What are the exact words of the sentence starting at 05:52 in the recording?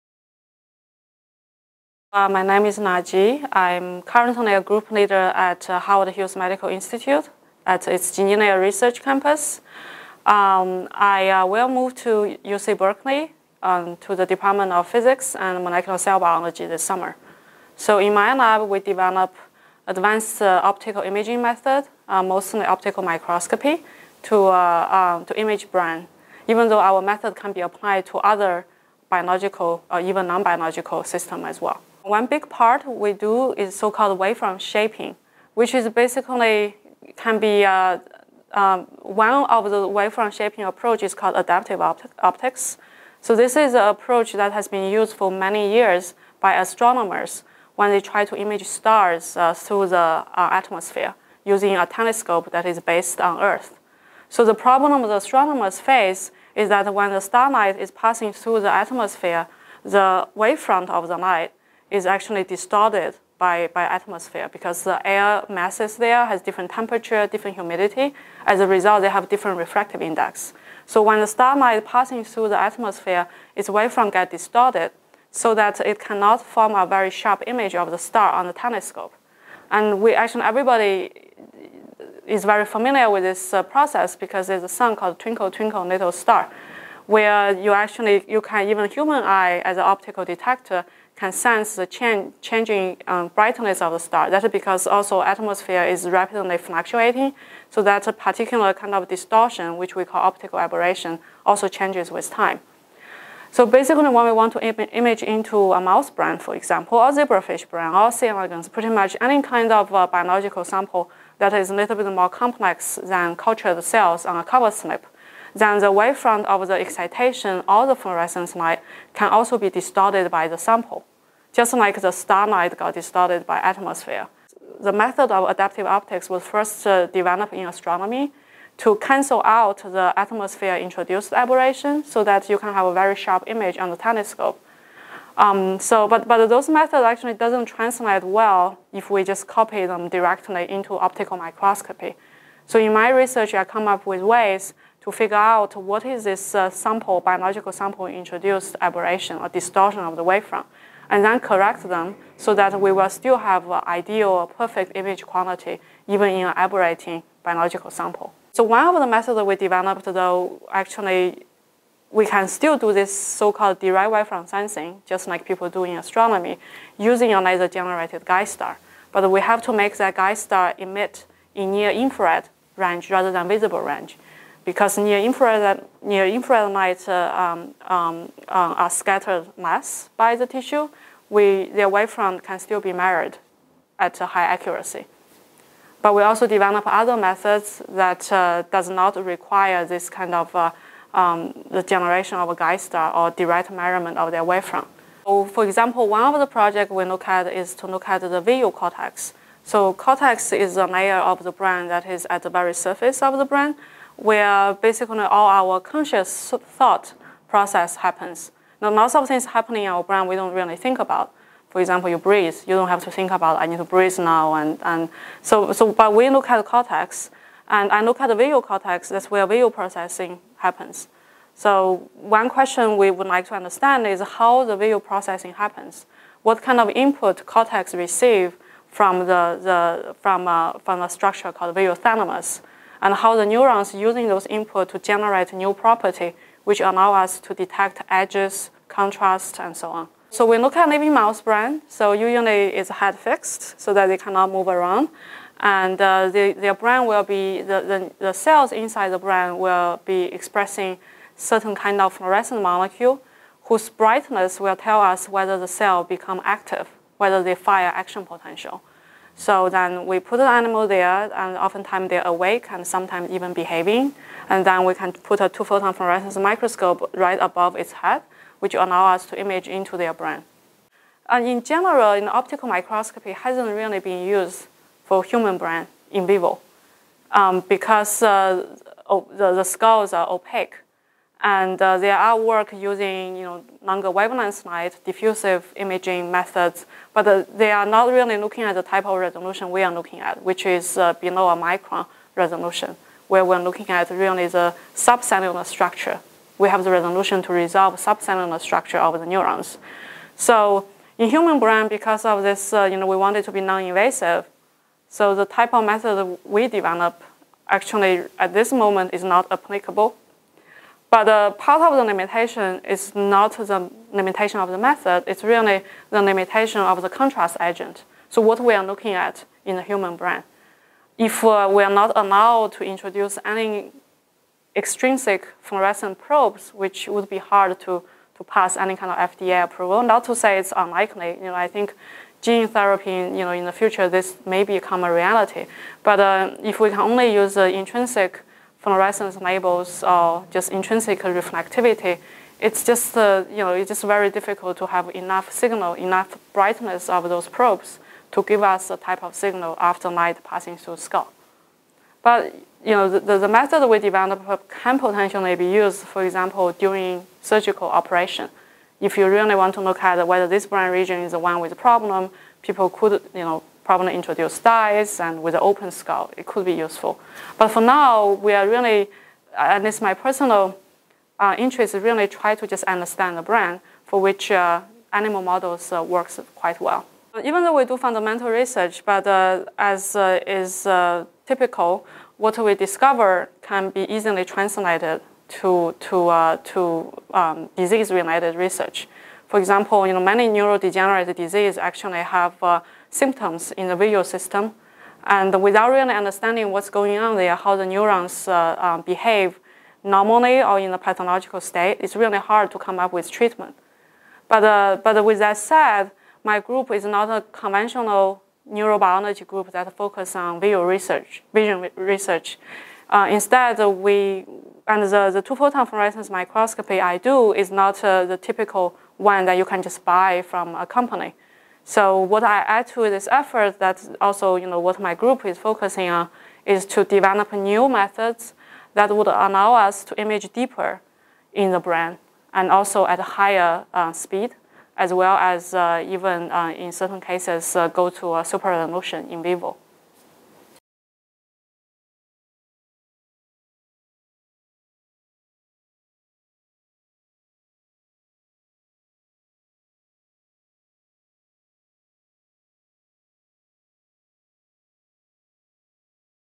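But you know the, the method we developed can potentially be used, for example, during surgical operation.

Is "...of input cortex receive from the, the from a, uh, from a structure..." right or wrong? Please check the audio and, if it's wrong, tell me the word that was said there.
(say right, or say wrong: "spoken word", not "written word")
right.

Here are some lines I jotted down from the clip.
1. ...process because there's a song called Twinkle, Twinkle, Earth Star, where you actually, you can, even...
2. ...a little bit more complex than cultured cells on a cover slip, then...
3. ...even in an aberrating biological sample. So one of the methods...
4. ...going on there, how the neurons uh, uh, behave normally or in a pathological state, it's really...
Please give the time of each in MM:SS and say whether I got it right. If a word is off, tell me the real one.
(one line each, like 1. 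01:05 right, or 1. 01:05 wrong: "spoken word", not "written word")
1. 01:23 wrong: "Little", not "Earth"
2. 01:51 right
3. 02:36 right
4. 06:36 right.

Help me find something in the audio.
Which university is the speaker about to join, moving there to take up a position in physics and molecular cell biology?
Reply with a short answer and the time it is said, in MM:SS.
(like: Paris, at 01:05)
UC Berkeley, at 00:12.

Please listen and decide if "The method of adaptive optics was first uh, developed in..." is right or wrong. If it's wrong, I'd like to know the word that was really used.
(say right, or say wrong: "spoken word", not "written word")
right.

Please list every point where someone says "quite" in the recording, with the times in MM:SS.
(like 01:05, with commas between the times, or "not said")
06:16.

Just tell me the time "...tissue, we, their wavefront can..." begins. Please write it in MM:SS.
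03:00.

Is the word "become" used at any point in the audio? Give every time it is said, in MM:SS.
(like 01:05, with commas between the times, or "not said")
04:16, 05:34.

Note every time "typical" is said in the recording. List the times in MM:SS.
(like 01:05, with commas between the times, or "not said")
06:21, 06:58.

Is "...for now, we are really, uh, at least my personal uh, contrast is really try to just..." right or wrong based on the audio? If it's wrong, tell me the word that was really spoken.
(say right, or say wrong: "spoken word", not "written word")
wrong: "interest", not "contrast".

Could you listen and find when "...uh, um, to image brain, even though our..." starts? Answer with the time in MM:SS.
00:24.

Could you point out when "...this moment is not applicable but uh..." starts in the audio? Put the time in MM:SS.
05:08.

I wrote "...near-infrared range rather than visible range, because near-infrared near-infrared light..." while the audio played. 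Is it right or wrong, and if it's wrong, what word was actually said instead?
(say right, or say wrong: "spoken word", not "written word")
right.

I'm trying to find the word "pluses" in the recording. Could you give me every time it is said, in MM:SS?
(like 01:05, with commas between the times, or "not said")
not said.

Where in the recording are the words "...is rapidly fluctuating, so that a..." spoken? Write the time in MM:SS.
01:35.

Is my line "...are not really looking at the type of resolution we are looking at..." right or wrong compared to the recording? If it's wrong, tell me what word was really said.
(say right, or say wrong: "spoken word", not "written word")
right.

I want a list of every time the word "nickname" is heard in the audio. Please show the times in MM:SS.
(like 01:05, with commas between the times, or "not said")
not said.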